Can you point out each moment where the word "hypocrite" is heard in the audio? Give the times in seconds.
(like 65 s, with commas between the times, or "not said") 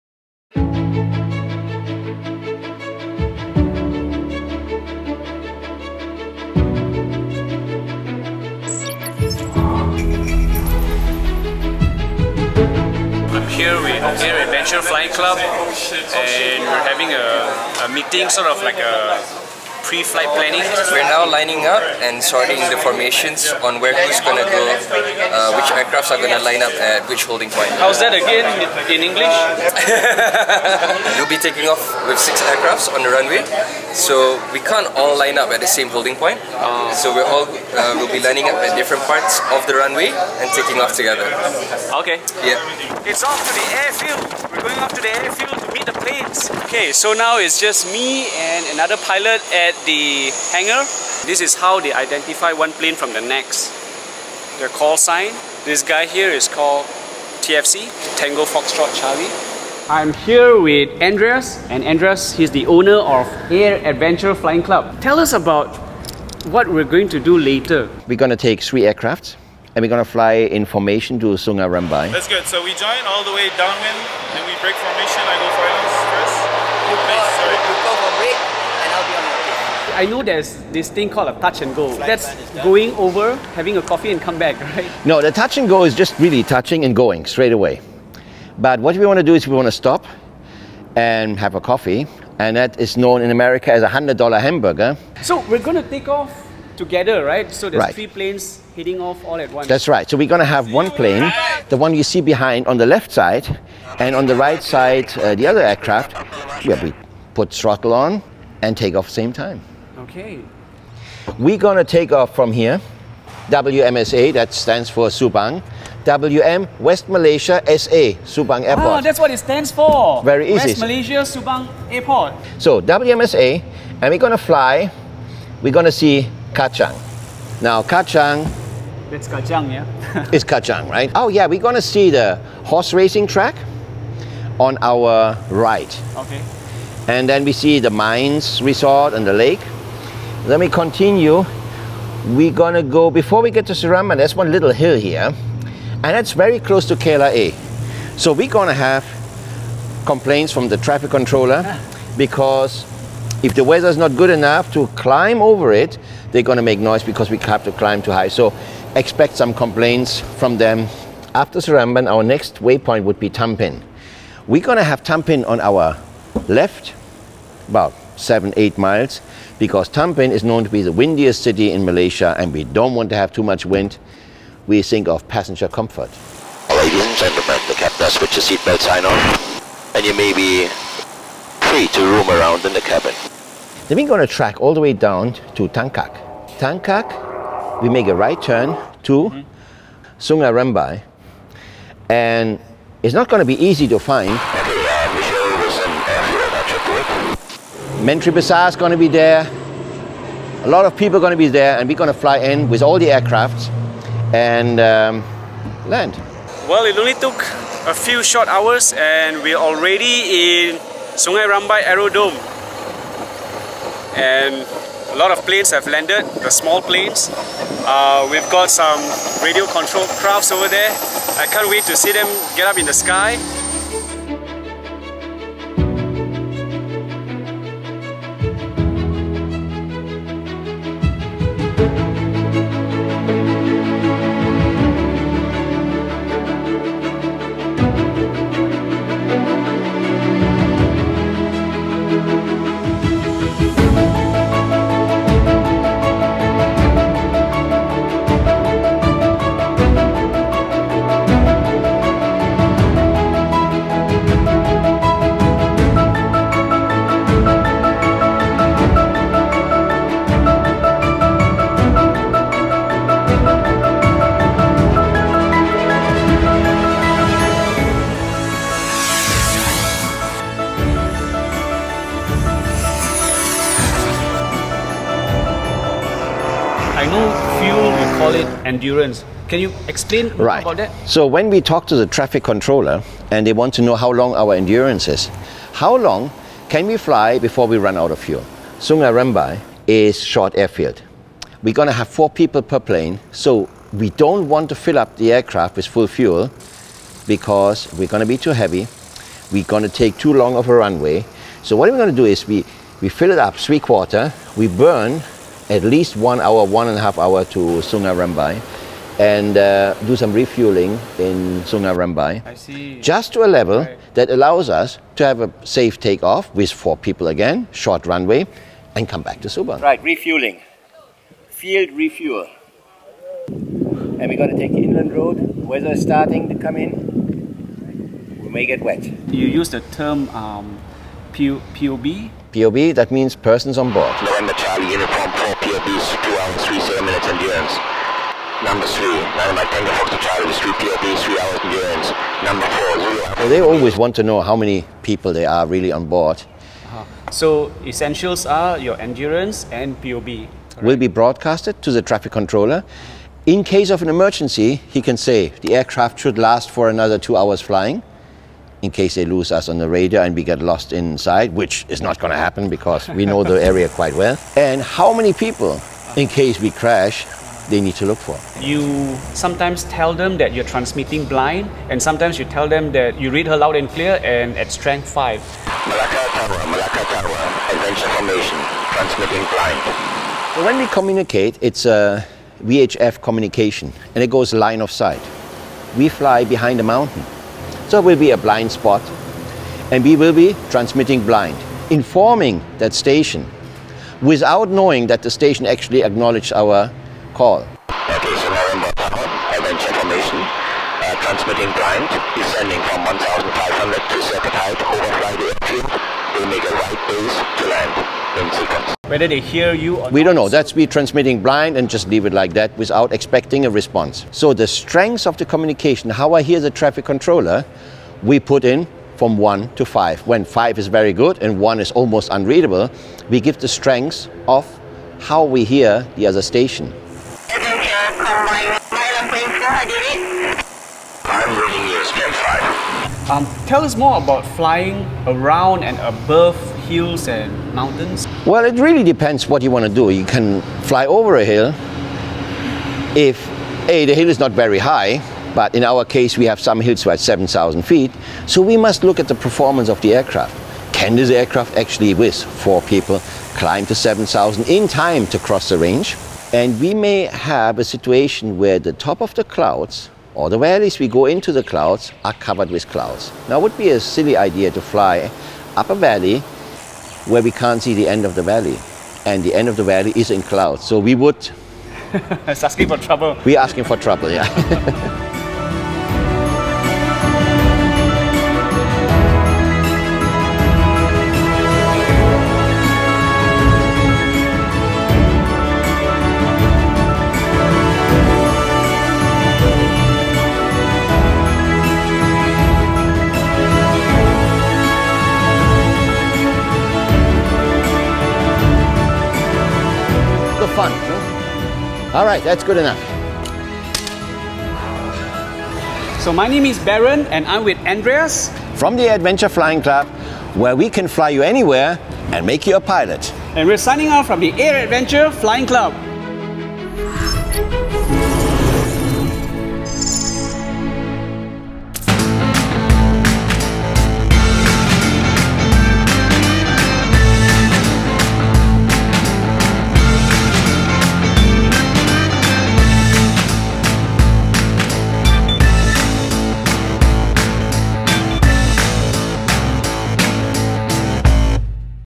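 not said.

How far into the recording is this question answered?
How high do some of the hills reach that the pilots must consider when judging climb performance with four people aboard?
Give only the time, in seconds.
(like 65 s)
447 s.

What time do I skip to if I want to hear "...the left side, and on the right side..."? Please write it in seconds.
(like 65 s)
102 s.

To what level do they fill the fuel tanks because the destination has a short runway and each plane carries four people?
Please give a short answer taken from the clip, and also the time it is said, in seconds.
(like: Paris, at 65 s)
Three quarter, at 303 s.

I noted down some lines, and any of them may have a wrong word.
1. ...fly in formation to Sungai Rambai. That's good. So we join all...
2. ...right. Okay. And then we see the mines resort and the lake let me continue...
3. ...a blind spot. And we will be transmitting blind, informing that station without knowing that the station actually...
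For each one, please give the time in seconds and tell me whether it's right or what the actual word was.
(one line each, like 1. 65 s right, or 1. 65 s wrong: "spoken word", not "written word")
1. 70 s right
2. 135 s right
3. 388 s right.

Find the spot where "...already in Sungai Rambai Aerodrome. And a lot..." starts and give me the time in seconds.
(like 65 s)
209 s.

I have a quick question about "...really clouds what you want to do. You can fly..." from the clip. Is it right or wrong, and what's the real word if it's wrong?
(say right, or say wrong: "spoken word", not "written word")
wrong: "depends", not "clouds".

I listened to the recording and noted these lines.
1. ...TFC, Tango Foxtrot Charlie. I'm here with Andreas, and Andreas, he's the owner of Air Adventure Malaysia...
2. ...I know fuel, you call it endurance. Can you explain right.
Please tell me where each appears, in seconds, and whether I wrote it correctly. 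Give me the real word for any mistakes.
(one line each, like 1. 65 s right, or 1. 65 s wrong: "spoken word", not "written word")
1. 57 s wrong: "Flying", not "Malaysia"
2. 277 s right.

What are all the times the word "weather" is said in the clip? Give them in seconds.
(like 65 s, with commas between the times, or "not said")
153 s, 325 s.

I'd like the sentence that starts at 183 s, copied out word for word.
Then we're going to track all the way down to Tangkak.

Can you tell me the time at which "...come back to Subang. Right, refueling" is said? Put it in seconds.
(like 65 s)
319 s.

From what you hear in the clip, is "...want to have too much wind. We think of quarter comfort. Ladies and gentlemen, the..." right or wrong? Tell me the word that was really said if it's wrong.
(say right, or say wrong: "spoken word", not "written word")
wrong: "passenger", not "quarter".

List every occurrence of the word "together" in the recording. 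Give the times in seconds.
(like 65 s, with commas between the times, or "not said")
40 s, 96 s.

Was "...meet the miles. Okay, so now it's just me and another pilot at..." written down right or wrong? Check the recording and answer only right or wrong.
wrong.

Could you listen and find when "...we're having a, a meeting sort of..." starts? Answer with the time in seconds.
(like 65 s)
16 s.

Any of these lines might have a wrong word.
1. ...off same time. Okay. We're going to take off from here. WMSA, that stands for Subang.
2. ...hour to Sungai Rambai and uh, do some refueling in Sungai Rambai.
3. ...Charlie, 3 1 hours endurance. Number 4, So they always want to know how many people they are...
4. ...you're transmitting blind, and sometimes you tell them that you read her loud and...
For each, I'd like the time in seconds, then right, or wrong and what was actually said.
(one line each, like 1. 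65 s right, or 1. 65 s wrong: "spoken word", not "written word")
1. 108 s right
2. 307 s right
3. 340 s wrong: "3", not "1"
4. 370 s right.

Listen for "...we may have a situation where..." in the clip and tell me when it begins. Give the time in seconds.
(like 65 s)
456 s.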